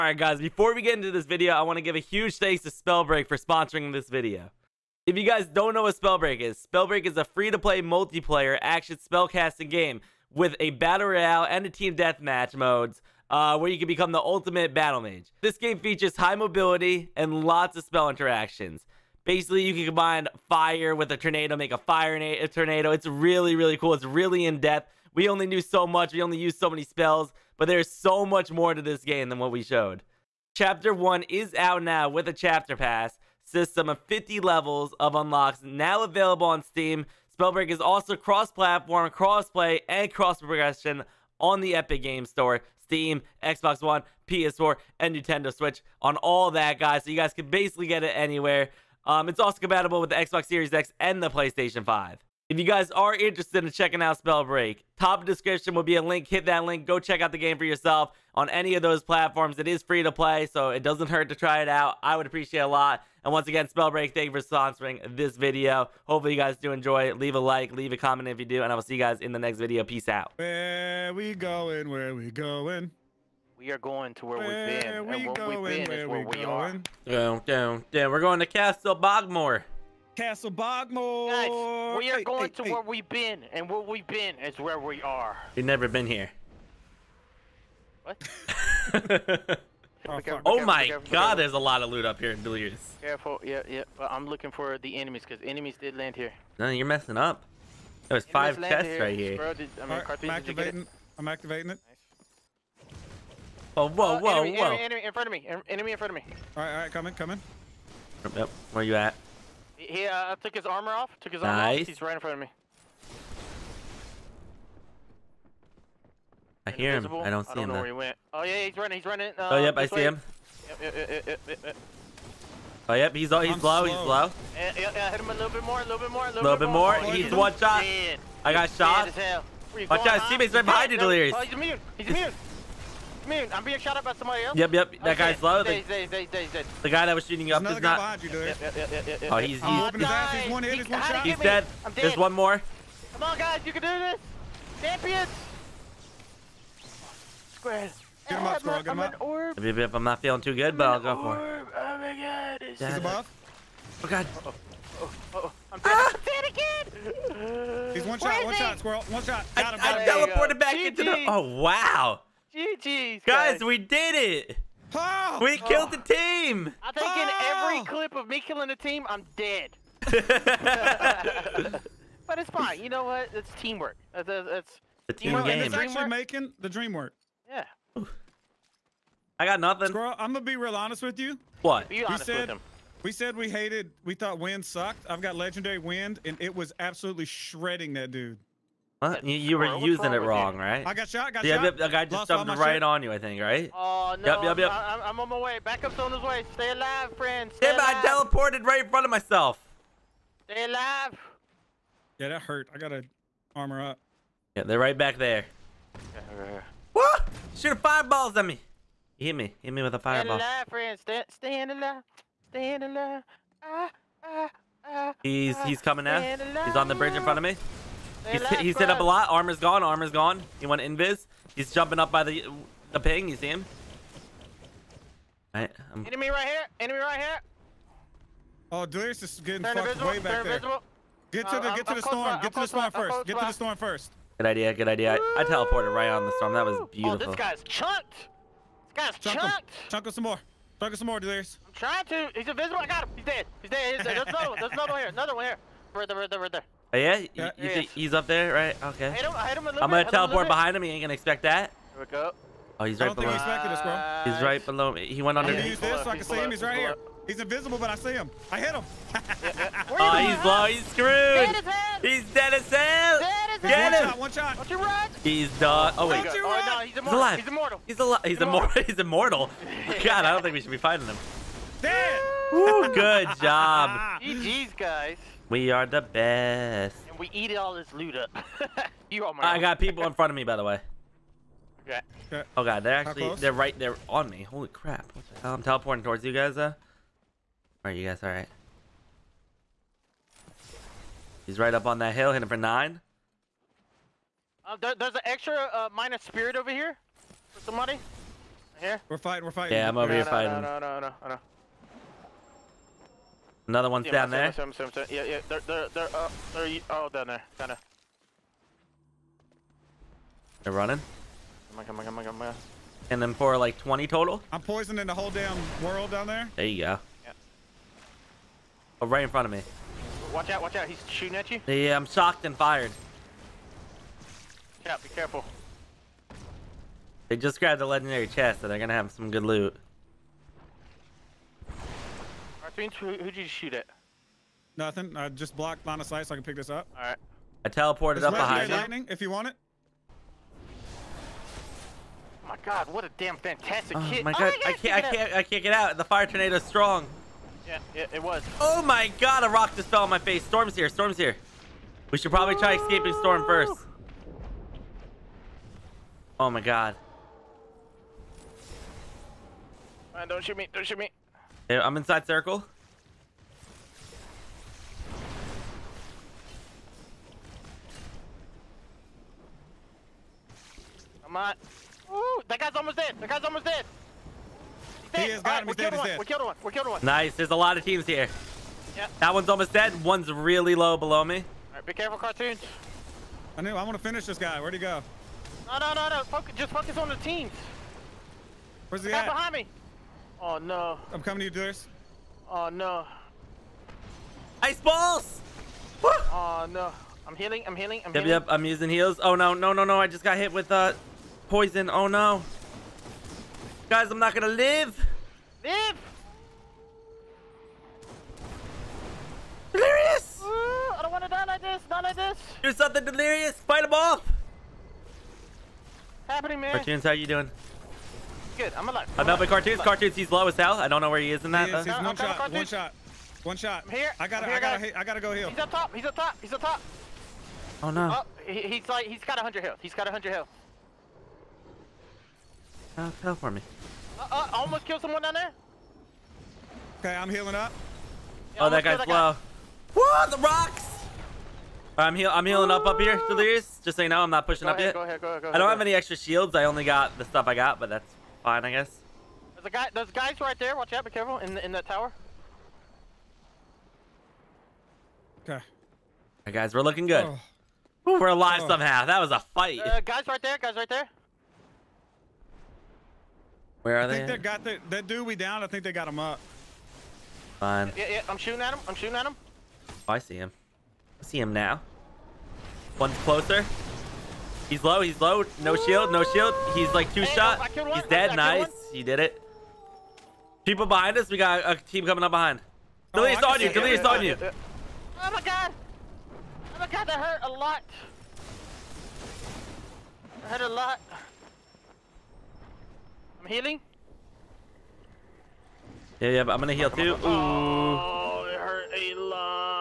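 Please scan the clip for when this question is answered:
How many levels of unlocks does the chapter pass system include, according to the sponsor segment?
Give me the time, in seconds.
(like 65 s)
34 s.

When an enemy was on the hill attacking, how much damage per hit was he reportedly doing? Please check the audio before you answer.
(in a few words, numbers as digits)
9.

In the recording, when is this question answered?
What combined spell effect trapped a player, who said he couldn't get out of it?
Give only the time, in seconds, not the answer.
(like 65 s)
346 s.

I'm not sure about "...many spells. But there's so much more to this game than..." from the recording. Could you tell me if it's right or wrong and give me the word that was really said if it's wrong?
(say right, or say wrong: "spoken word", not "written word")
right.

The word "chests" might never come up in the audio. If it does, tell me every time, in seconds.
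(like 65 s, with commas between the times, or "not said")
98 s, 328 s.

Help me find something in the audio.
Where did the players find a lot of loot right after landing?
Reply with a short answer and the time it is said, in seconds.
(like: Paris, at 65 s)
Billiards, at 92 s.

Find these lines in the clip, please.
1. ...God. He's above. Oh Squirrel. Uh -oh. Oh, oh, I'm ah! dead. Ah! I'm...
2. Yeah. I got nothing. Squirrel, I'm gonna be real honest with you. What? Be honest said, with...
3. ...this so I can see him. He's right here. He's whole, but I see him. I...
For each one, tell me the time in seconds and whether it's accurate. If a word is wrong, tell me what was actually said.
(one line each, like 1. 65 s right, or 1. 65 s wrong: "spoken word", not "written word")
1. 152 s wrong: "God", not "Squirrel"
2. 177 s right
3. 255 s wrong: "invisible", not "whole".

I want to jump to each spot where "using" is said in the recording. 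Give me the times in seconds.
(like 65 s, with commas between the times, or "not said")
189 s, 398 s.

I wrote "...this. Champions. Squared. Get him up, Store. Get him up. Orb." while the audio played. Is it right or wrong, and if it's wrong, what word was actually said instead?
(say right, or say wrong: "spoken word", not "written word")
wrong: "Squirrel", not "Store".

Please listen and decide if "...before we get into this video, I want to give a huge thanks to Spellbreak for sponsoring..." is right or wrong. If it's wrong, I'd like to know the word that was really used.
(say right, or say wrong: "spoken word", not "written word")
right.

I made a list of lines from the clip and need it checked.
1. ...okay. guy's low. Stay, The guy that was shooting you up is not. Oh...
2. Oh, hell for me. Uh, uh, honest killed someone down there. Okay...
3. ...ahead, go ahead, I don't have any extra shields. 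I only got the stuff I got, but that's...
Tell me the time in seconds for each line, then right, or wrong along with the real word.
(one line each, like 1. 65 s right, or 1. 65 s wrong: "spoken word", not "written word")
1. 135 s right
2. 432 s wrong: "almost", not "honest"
3. 445 s right.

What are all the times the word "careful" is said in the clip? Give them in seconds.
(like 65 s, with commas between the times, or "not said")
92 s, 325 s, 381 s, 451 s.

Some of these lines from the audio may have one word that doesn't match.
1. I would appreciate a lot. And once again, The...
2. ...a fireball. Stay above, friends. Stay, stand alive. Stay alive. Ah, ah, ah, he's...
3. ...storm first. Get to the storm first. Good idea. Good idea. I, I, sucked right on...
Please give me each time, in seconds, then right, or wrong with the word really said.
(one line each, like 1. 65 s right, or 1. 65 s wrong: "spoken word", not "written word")
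1. 62 s wrong: "Spellbreak", not "The"
2. 209 s wrong: "alive", not "above"
3. 232 s wrong: "teleported", not "sucked".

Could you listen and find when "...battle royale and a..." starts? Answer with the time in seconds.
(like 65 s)
10 s.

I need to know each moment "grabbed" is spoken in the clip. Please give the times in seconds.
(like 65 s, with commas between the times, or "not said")
327 s.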